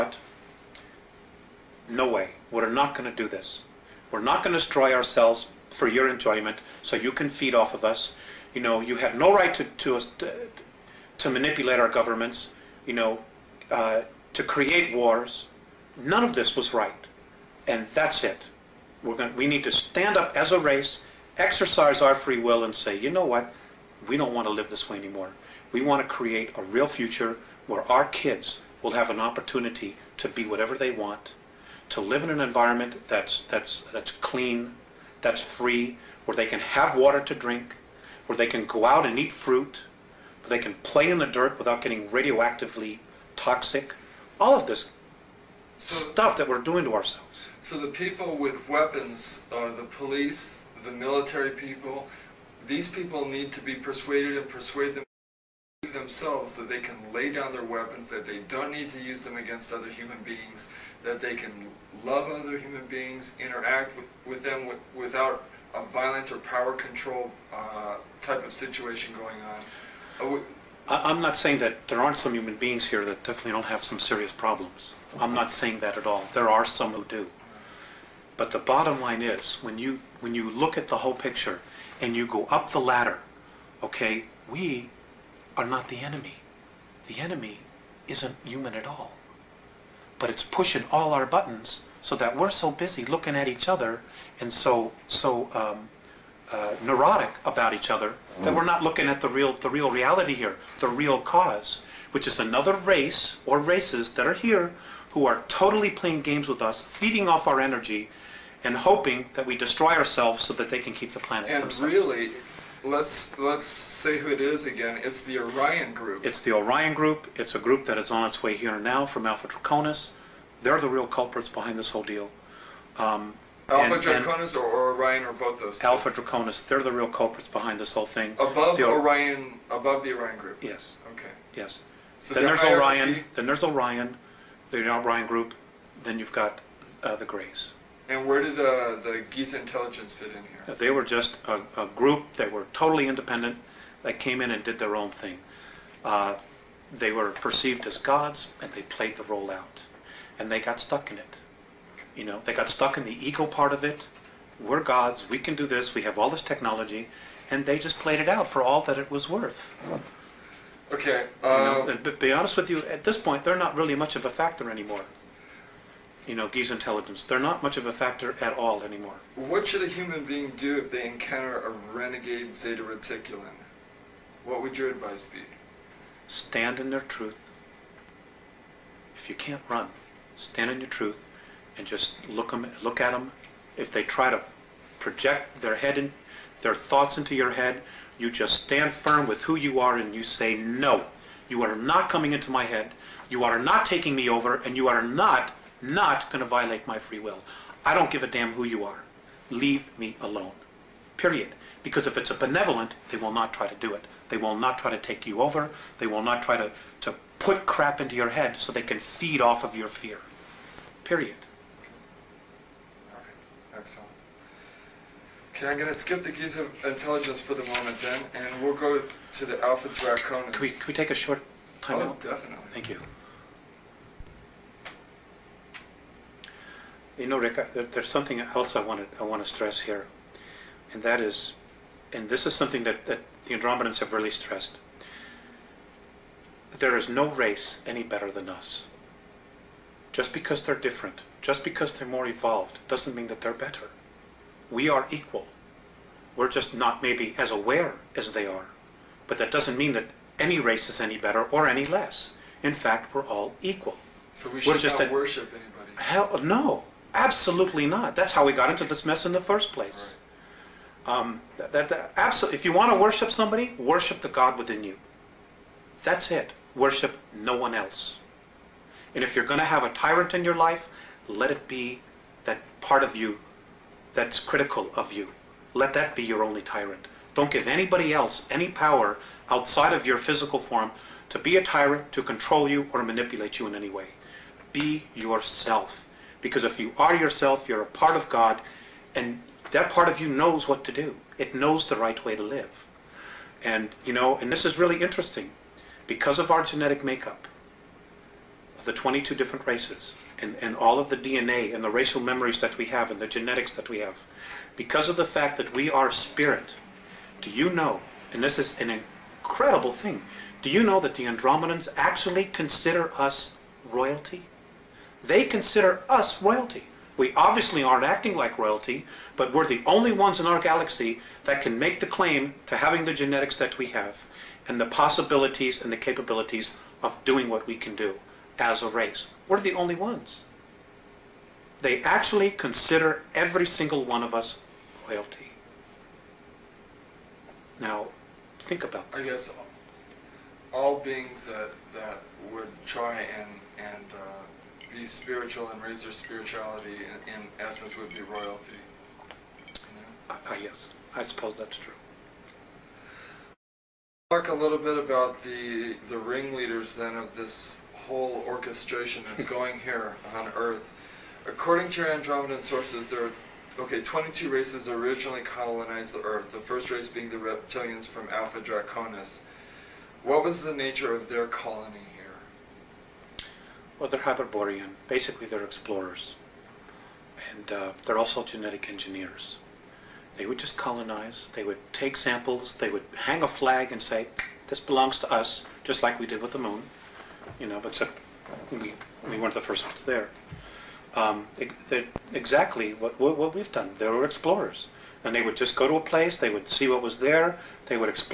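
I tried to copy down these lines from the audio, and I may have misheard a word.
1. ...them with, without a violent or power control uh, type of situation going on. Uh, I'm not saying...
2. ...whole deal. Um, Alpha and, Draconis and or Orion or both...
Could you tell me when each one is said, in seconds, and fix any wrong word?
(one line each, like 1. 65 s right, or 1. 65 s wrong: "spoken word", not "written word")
1. 64 s right
2. 121 s right.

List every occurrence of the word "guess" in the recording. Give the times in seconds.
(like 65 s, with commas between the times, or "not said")
339 s.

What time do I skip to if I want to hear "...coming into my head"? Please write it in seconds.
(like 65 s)
192 s.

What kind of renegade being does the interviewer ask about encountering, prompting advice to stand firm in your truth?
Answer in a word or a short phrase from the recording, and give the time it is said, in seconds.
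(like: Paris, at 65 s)
Zeta Reticulan, at 172 s.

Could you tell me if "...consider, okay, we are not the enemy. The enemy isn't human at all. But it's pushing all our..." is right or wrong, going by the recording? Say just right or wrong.
wrong.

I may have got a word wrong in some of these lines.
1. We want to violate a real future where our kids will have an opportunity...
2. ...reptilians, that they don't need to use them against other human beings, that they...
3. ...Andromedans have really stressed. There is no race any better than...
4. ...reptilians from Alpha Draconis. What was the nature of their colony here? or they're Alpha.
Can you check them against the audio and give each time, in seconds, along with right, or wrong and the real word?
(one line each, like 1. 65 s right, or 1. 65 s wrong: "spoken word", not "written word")
1. 25 s wrong: "create", not "violate"
2. 57 s wrong: "weapons", not "reptilians"
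3. 233 s right
4. 367 s wrong: "Hyperborean", not "Alpha".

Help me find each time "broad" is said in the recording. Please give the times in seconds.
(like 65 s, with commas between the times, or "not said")
not said.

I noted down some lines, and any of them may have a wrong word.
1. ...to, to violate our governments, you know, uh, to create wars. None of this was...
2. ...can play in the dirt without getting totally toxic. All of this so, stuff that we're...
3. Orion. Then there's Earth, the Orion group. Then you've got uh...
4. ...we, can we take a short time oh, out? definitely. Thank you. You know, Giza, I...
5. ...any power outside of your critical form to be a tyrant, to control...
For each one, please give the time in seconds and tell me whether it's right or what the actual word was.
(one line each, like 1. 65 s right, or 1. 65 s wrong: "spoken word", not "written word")
1. 10 s wrong: "manipulate", not "violate"
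2. 40 s wrong: "radioactively", not "totally"
3. 133 s wrong: "Orion", not "Earth"
4. 220 s wrong: "Rick", not "Giza"
5. 278 s wrong: "physical", not "critical".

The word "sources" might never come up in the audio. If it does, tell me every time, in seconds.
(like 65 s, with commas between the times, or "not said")
362 s.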